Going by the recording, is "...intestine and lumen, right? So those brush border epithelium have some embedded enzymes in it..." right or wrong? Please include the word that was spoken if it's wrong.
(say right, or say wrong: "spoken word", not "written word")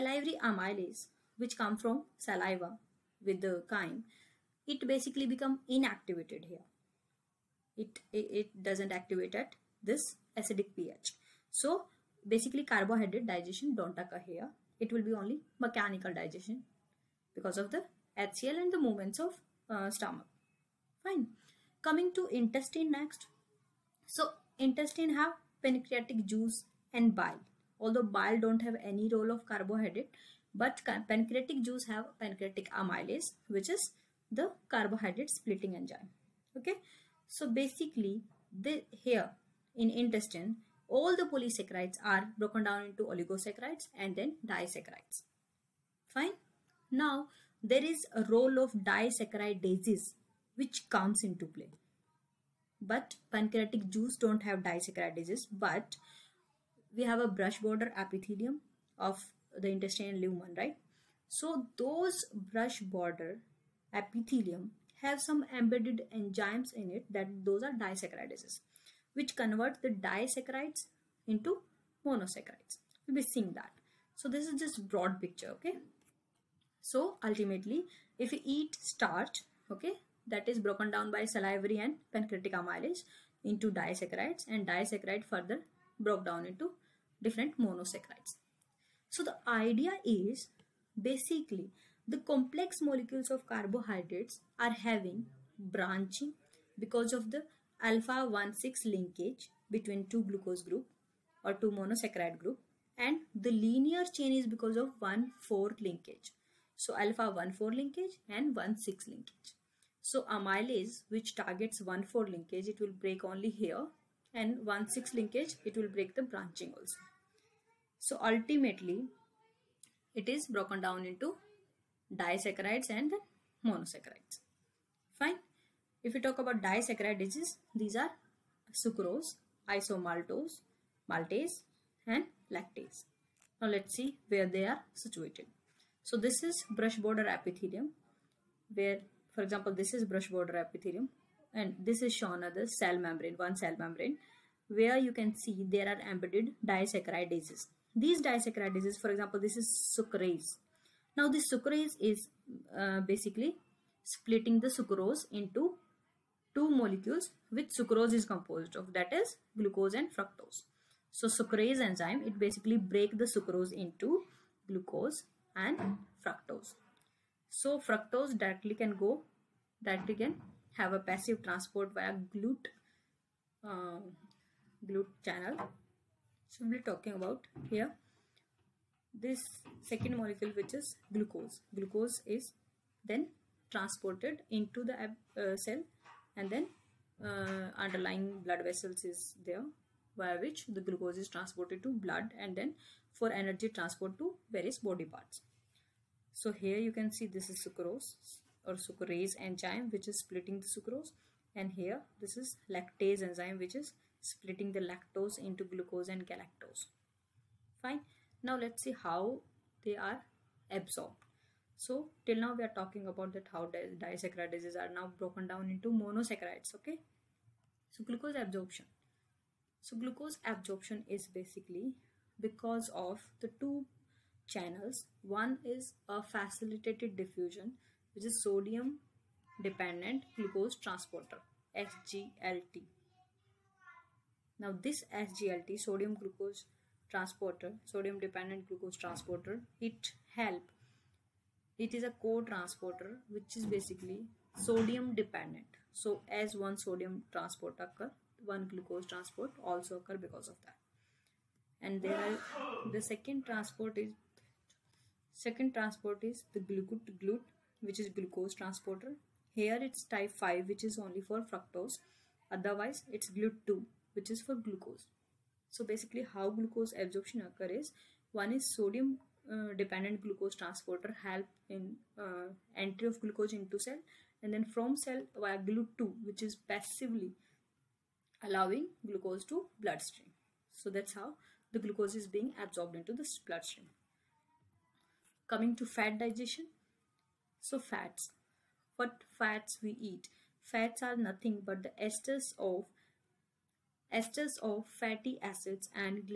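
right.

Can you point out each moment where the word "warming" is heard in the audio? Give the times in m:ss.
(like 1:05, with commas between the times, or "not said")
not said.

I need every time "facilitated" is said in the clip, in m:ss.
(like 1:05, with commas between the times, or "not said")
3:46.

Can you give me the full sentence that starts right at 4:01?
It is a co-transporter which is basically sodium dependent.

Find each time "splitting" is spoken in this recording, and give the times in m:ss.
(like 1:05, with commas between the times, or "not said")
0:35, 2:34, 3:20, 3:24.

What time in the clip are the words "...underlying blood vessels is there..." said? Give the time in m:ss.
3:07.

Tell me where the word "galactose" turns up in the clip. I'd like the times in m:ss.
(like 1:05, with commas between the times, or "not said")
3:26.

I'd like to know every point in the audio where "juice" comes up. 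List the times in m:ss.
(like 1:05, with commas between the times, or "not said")
0:26, 0:31, 0:53.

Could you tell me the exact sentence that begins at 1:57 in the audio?
So ultimately, it is broken down into disaccharides and monosaccharides.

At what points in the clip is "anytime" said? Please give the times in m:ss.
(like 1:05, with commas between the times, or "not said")
not said.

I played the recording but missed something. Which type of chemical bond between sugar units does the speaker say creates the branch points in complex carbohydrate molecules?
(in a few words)
Alpha 1,6 linkage.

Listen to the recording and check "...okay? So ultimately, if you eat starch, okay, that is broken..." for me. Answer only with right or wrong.
right.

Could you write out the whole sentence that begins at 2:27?
These disaccharidases, for example, this is sucrase.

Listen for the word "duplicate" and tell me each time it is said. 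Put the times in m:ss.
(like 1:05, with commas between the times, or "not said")
not said.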